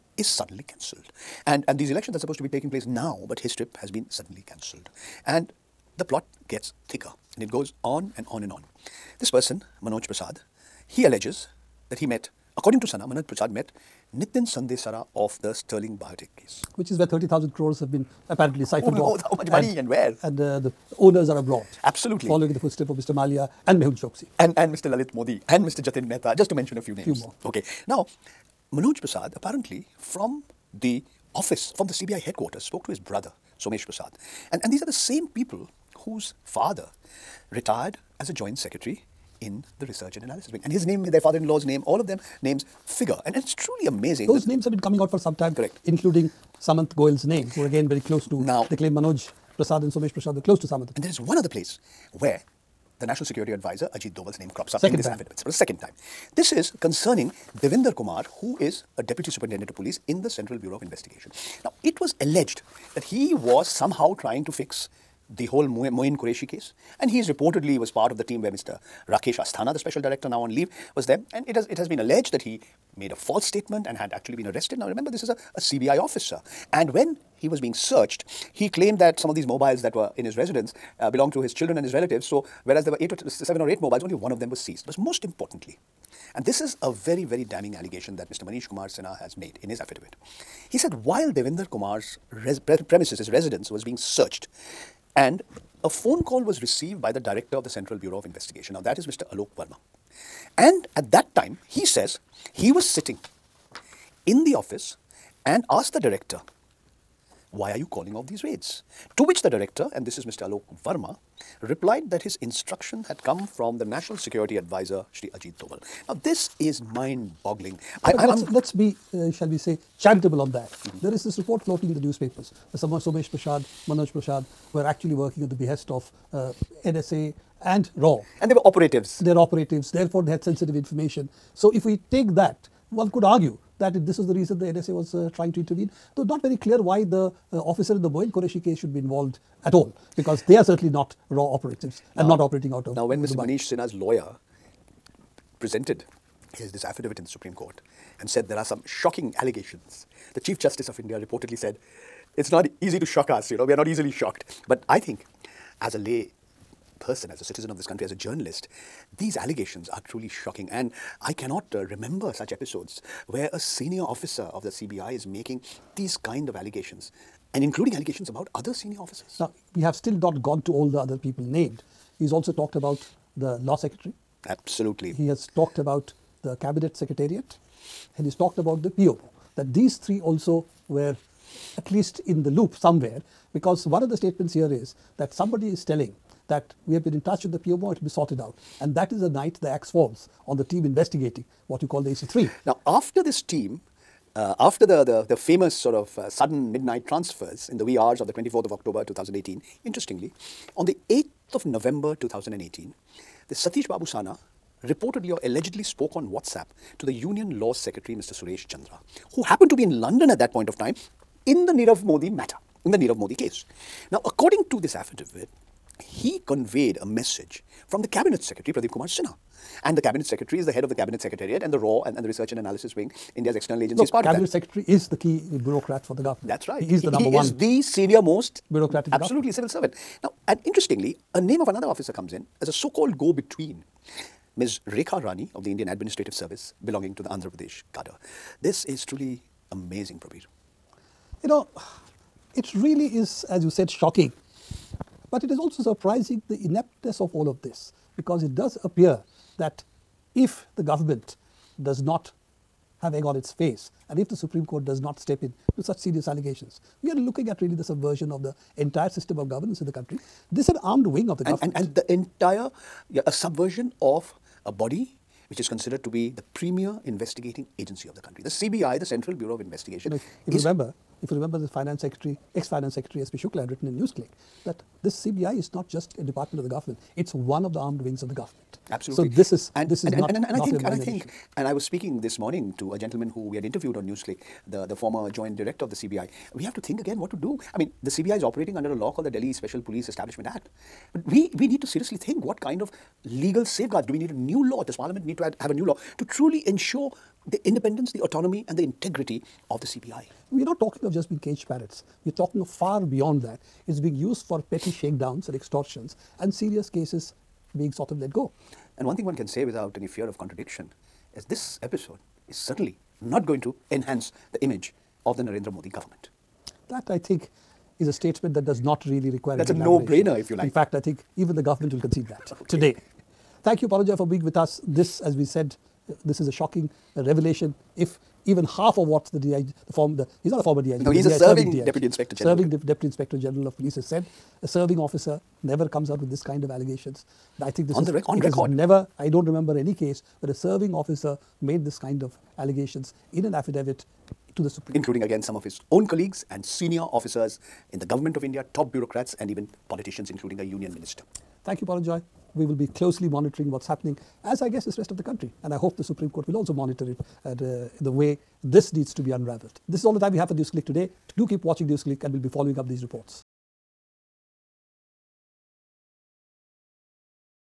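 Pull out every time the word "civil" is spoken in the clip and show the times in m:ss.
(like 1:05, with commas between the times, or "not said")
3:49.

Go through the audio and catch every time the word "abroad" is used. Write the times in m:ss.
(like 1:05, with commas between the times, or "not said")
0:21.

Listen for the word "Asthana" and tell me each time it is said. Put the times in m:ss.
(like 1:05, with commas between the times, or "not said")
1:09.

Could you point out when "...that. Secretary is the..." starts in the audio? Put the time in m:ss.
3:44.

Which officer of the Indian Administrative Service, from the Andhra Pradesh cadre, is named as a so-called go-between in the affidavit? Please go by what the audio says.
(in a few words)
Rekha Rani.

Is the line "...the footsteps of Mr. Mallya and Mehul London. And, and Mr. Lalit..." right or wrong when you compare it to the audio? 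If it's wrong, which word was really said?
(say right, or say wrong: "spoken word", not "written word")
wrong: "Choksi", not "London".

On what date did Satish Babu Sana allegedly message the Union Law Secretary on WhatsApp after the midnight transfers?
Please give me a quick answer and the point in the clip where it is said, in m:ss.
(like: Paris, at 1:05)
8 November 2018, at 3:21.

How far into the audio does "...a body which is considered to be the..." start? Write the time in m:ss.
4:24.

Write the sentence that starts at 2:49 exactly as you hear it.
Now, we have still not gone to all the other people named.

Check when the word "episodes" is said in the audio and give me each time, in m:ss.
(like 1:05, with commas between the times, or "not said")
2:42, 5:11.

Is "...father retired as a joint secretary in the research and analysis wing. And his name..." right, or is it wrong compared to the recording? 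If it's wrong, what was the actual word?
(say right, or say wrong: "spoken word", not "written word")
right.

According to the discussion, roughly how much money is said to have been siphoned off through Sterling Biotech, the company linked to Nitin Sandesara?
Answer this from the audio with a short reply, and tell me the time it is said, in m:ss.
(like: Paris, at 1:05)
30,000 crores, at 0:17.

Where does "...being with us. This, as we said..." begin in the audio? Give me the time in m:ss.
5:24.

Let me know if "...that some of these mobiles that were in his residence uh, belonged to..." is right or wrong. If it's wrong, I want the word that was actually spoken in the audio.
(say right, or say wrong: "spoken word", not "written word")
right.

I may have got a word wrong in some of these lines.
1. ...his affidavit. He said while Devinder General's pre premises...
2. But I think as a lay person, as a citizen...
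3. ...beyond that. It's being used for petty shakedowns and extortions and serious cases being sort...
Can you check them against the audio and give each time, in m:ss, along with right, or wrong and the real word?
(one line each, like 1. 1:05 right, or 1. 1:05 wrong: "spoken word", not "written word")
1. 1:29 wrong: "Kumar", not "General"
2. 2:34 right
3. 5:02 right.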